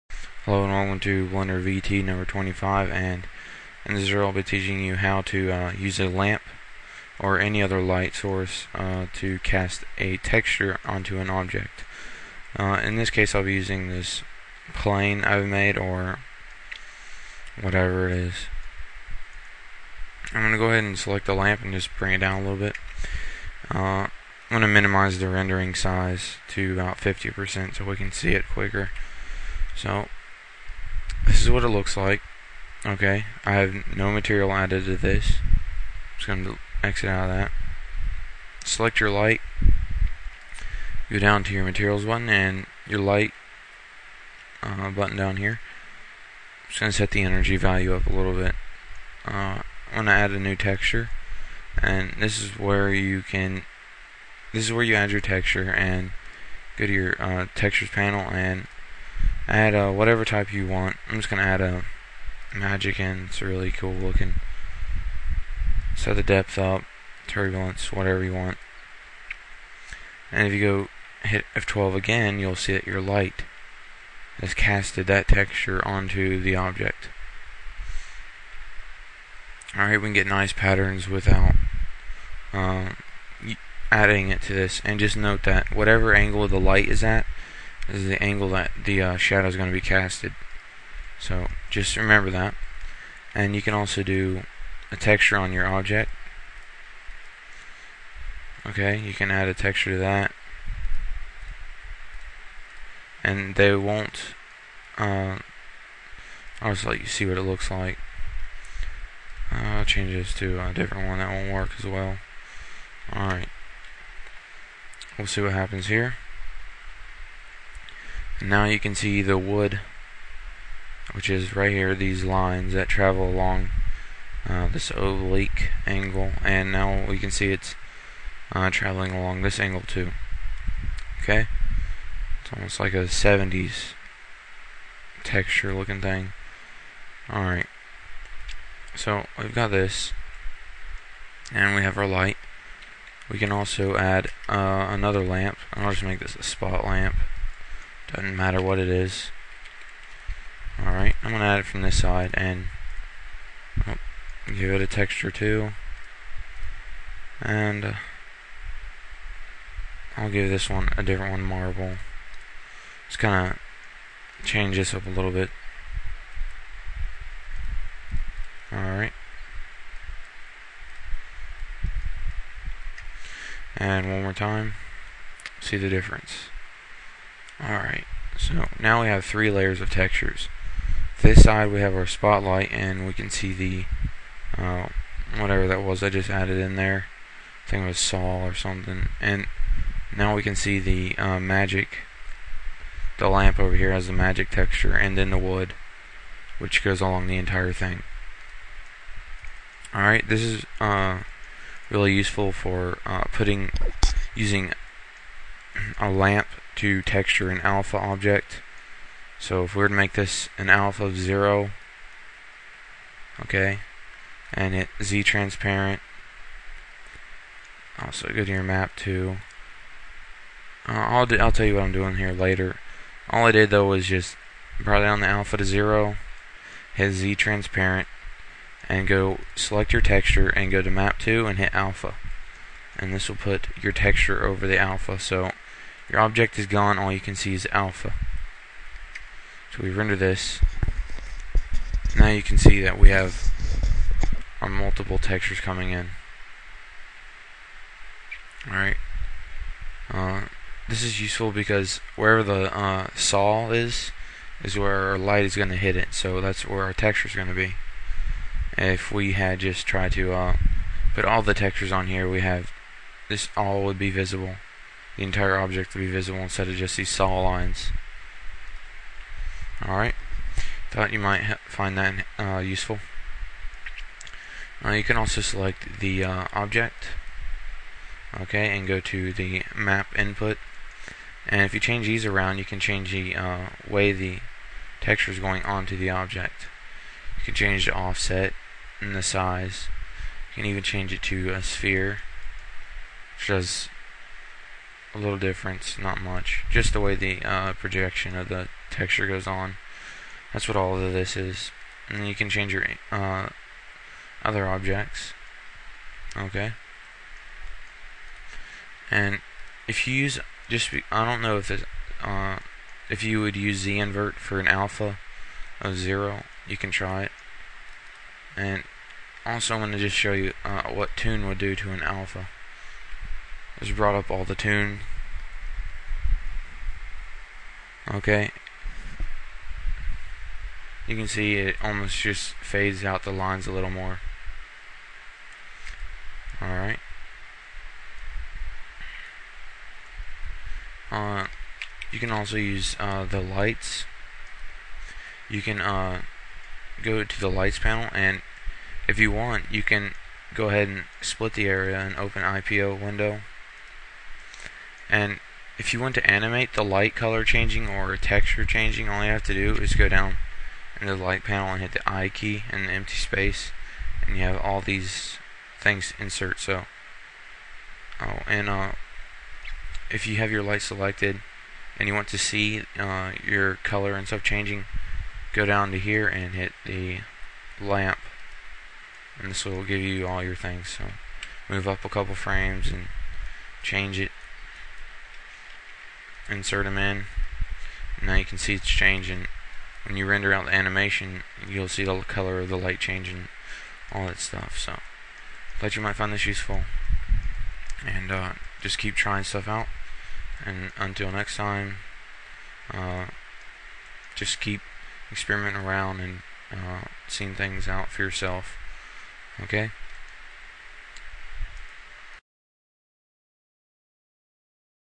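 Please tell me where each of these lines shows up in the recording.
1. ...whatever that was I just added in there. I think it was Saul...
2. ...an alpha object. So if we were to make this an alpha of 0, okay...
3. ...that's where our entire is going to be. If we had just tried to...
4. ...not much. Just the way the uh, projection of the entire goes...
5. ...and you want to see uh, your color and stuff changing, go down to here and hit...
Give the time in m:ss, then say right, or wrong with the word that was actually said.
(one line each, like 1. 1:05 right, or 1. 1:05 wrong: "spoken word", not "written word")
1. 3:05 right
2. 3:27 right
3. 4:16 wrong: "texture", not "entire"
4. 4:55 wrong: "texture", not "entire"
5. 6:11 right.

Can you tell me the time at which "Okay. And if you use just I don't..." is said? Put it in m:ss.
5:06.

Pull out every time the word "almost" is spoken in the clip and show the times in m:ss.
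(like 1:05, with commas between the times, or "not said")
2:12, 5:31.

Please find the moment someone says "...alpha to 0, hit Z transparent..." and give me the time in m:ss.
3:45.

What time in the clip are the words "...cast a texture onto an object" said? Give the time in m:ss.
0:09.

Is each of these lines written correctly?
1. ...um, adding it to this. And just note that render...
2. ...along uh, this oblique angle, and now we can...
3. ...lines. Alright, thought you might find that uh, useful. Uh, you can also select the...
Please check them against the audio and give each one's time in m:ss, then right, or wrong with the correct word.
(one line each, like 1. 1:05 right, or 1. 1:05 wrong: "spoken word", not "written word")
1. 1:22 wrong: "whatever", not "render"
2. 2:03 right
3. 4:27 right.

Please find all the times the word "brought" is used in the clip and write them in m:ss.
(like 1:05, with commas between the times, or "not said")
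3:44, 5:23.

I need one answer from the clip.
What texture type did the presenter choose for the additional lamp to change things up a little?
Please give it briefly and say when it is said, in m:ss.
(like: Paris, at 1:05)
Marble, at 2:41.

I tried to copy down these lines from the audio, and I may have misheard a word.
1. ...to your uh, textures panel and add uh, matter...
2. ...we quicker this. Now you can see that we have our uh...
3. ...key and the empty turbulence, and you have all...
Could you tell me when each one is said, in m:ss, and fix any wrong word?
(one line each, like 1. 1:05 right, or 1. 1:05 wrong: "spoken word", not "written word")
1. 0:56 wrong: "whatever", not "matter"
2. 3:59 wrong: "render", not "quicker"
3. 6:02 wrong: "space", not "turbulence".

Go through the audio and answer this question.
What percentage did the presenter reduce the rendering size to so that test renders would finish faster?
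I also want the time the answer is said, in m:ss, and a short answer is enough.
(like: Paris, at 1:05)
50%, at 0:26.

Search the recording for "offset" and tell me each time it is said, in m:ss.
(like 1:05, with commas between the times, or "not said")
4:47.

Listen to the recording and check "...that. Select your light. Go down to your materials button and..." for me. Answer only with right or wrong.
right.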